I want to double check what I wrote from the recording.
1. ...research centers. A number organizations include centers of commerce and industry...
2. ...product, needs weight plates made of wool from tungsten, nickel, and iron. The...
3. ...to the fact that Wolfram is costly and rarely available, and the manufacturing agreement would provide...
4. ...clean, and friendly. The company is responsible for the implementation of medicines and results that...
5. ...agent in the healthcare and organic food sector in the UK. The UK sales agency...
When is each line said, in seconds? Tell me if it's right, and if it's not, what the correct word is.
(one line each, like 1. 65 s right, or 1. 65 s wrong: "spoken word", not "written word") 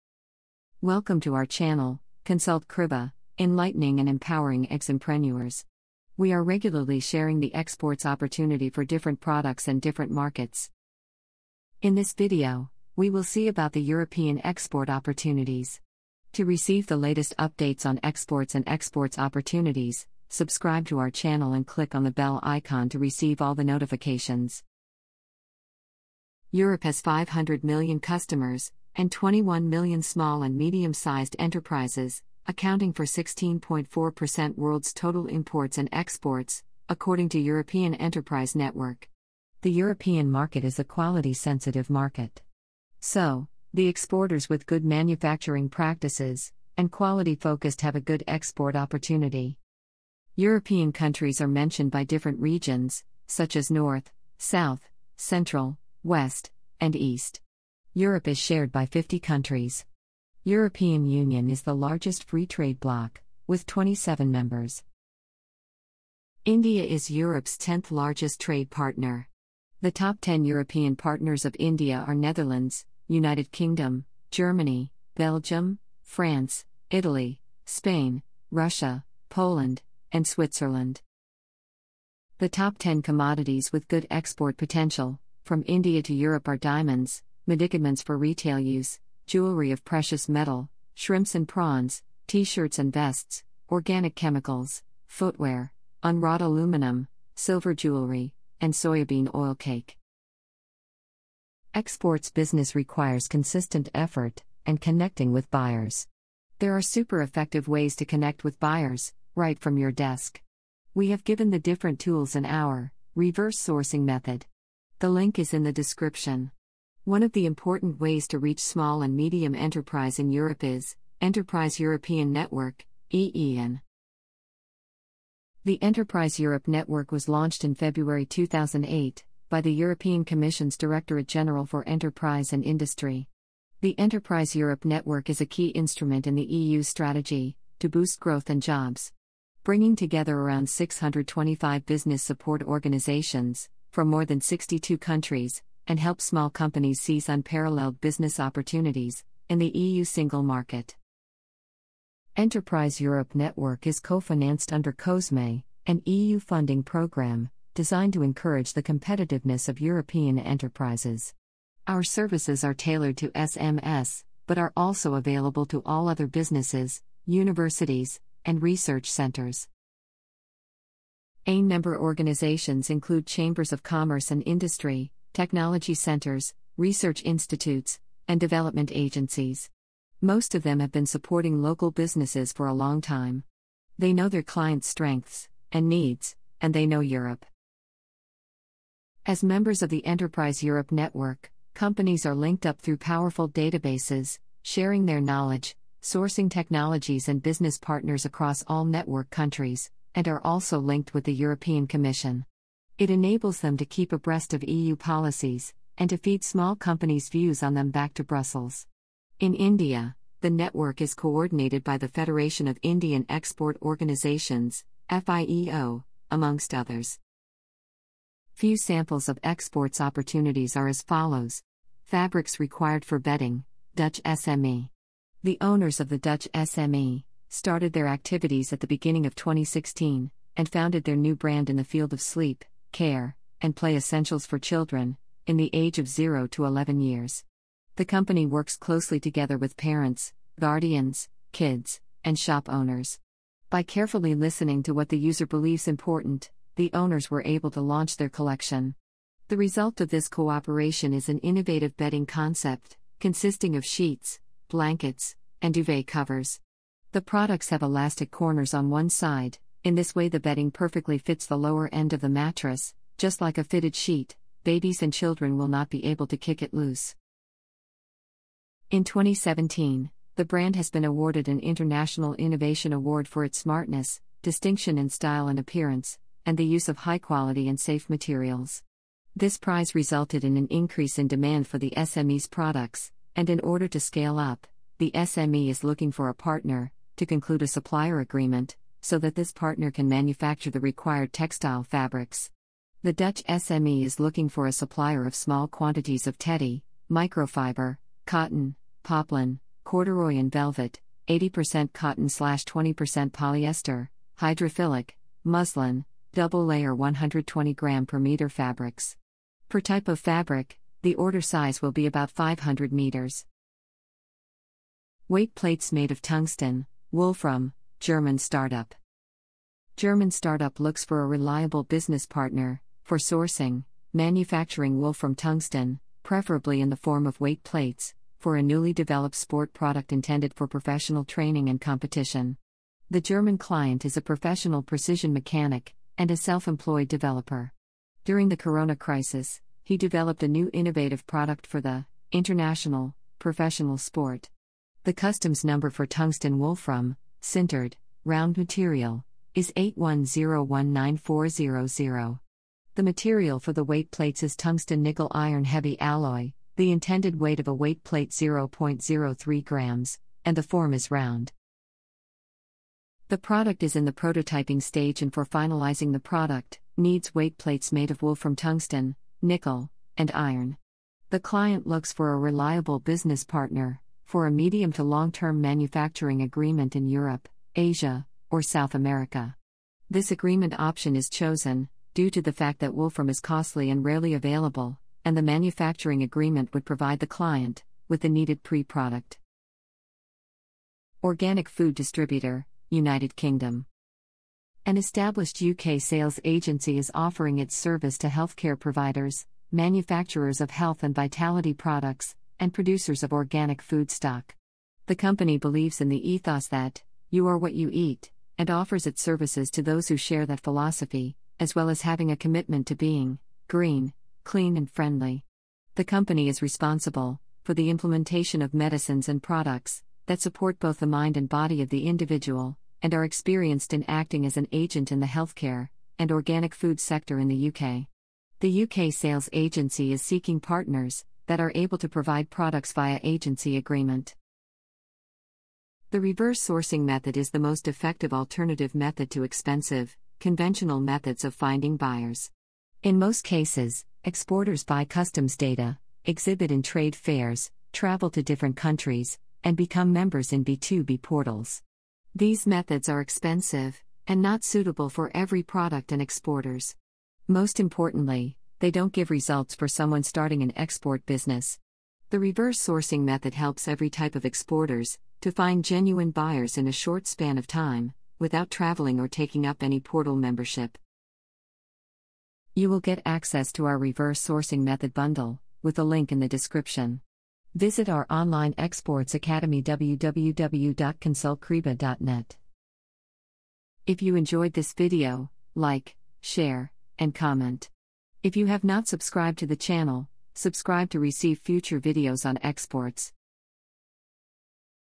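1. 168 s wrong: "chambers", not "centers"
2. 366 s right
3. 382 s right
4. 414 s wrong: "products", not "results"
5. 424 s right.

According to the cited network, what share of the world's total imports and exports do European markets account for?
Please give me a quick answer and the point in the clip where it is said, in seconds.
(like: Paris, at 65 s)
16.4%, at 33 s.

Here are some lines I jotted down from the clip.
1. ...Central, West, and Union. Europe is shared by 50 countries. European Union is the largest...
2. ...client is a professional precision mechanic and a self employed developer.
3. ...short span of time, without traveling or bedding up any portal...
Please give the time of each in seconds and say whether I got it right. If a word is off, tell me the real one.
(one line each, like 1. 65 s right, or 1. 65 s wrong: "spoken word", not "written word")
1. 55 s wrong: "East", not "Union"
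2. 333 s right
3. 466 s wrong: "taking", not "bedding".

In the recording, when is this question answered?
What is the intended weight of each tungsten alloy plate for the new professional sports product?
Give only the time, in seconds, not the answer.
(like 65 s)
358 s.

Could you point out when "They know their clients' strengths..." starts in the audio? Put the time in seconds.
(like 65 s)
183 s.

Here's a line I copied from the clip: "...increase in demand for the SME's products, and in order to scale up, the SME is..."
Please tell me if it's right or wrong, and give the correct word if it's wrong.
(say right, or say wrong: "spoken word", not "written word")
right.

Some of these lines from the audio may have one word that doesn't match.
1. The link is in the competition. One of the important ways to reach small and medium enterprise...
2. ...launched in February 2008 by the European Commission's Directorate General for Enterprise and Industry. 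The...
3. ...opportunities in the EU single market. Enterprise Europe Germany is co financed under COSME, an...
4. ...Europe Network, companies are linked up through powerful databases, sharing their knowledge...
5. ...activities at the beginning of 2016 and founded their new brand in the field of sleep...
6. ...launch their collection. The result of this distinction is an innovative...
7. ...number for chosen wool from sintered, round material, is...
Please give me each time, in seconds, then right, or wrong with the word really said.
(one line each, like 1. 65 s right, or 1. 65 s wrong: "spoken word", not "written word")
1. 114 s wrong: "description", not "competition"
2. 127 s right
3. 148 s wrong: "Network", not "Germany"
4. 190 s right
5. 228 s right
6. 247 s wrong: "cooperation", not "distinction"
7. 345 s wrong: "tungsten", not "chosen".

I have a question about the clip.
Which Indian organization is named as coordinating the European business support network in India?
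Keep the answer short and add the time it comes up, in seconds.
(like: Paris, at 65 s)
Federation of Indian Export Organizations, at 212 s.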